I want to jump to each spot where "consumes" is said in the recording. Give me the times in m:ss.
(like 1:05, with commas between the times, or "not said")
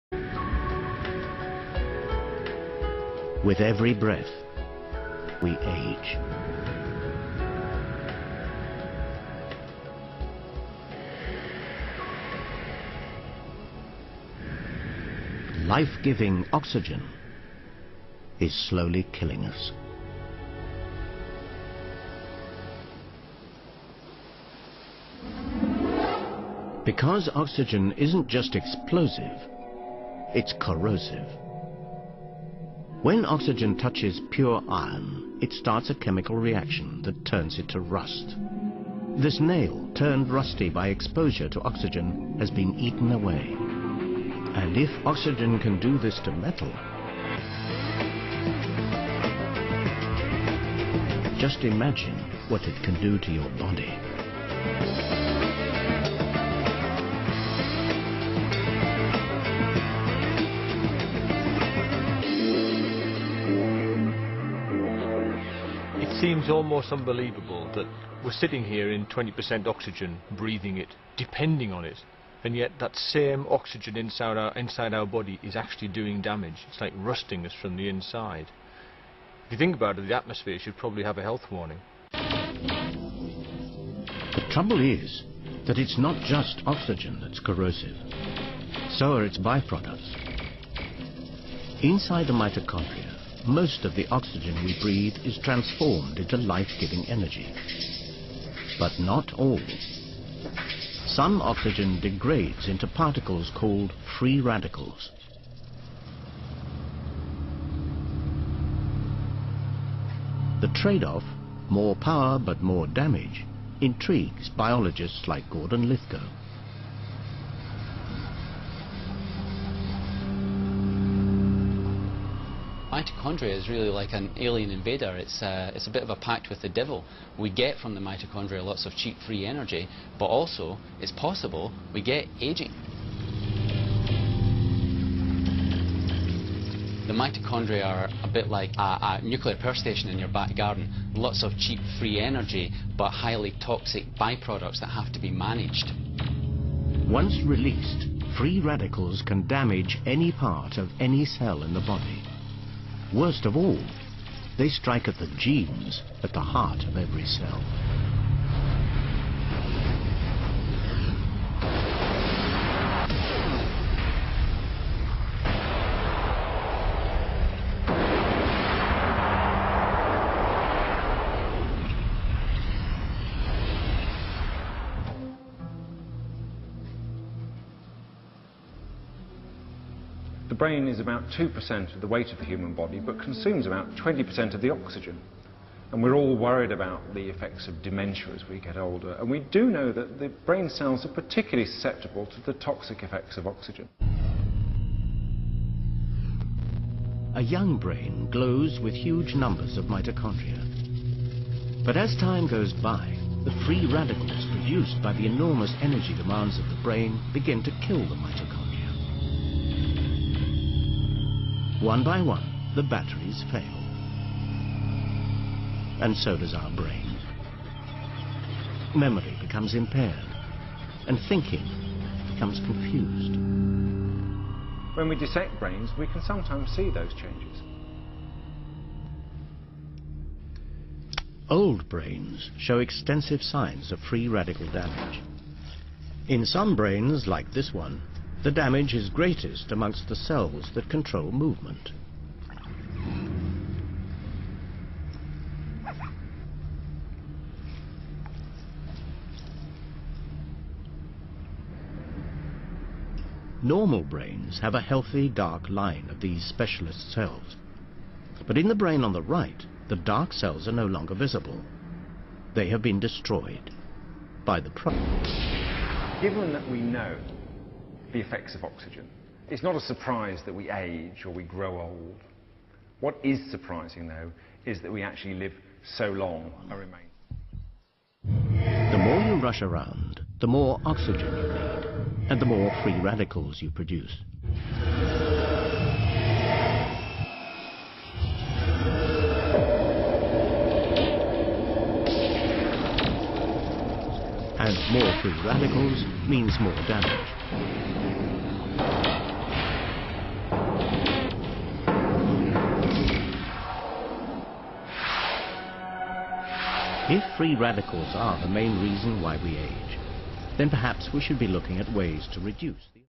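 3:03.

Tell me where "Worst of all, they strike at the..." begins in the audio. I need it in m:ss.
2:33.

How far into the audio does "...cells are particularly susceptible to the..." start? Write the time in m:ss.
3:10.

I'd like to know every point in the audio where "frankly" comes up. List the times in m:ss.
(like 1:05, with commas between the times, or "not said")
not said.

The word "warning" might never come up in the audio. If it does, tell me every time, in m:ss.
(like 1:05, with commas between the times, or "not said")
1:21.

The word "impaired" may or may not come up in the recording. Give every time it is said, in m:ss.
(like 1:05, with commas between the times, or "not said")
3:39.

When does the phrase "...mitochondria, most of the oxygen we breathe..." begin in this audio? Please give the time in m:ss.
1:32.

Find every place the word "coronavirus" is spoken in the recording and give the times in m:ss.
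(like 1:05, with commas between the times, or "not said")
not said.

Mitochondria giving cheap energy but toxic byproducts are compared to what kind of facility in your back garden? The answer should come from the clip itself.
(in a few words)
Nuclear power station.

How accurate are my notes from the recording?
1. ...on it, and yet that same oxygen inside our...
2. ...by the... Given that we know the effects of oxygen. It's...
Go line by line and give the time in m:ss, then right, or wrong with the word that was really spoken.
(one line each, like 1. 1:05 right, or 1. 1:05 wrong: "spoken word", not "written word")
1. 1:11 right
2. 4:24 right.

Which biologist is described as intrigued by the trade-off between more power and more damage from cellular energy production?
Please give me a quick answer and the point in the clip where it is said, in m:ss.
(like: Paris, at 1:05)
Gordon Lithgow, at 1:55.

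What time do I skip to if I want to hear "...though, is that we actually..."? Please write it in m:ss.
4:34.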